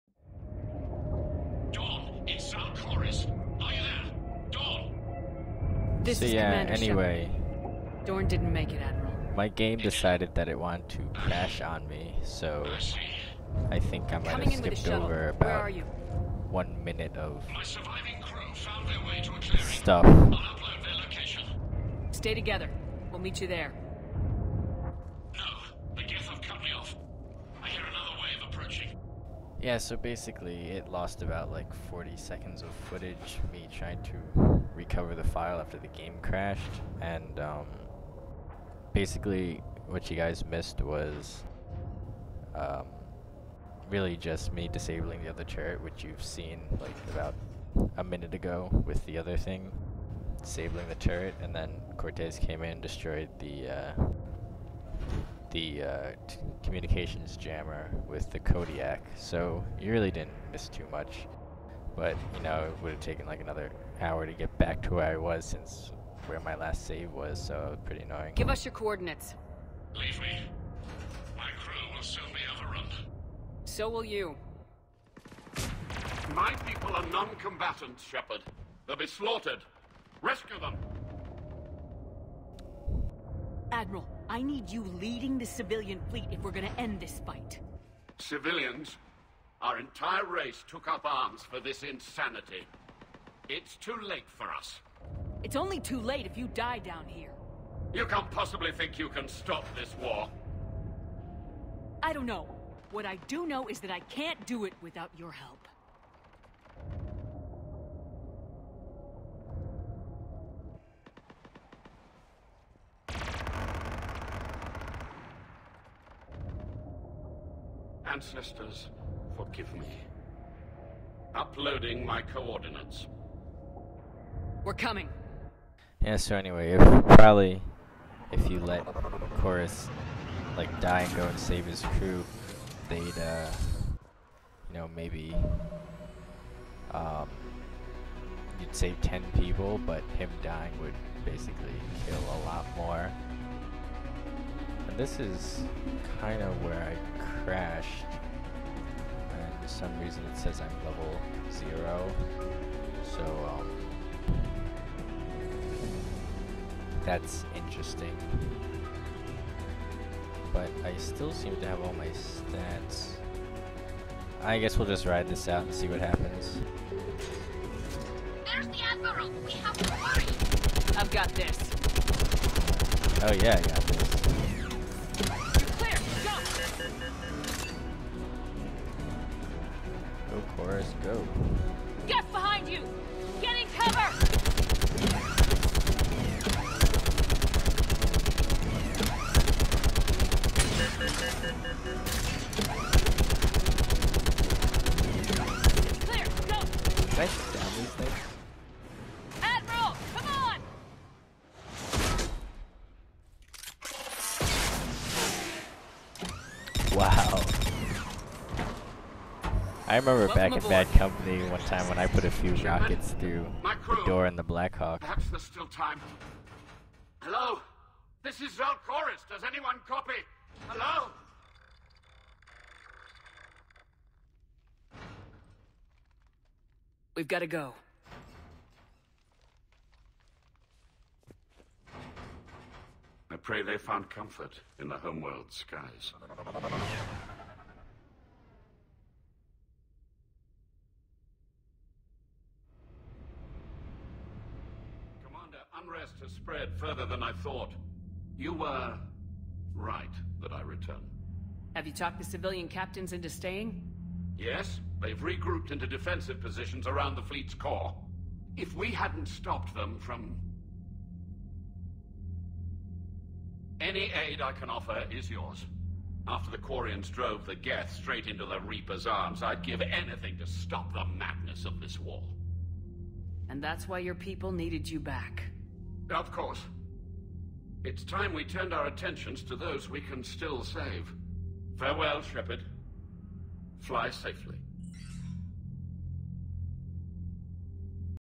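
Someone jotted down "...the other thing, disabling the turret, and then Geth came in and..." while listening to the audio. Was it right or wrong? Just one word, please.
wrong.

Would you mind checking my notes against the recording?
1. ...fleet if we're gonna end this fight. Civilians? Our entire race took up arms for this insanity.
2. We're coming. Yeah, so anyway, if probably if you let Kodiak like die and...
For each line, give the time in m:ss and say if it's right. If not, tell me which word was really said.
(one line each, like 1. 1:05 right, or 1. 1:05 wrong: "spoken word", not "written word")
1. 1:26 right
2. 2:04 wrong: "Koris", not "Kodiak".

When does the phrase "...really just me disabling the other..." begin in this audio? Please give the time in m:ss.
0:43.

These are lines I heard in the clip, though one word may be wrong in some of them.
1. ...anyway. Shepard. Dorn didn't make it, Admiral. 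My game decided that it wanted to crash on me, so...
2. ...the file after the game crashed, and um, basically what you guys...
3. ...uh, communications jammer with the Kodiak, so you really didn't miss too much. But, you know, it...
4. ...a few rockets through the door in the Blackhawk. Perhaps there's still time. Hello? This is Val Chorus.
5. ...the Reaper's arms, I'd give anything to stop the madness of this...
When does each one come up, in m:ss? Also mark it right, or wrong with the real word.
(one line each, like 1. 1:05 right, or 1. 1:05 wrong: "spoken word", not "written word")
1. 0:06 right
2. 0:35 right
3. 0:55 right
4. 3:32 right
5. 4:28 right.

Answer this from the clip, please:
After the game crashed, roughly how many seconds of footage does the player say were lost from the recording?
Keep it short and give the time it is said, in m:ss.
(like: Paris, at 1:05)
40 seconds, at 0:31.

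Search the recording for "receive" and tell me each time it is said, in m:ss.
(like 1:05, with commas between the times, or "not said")
not said.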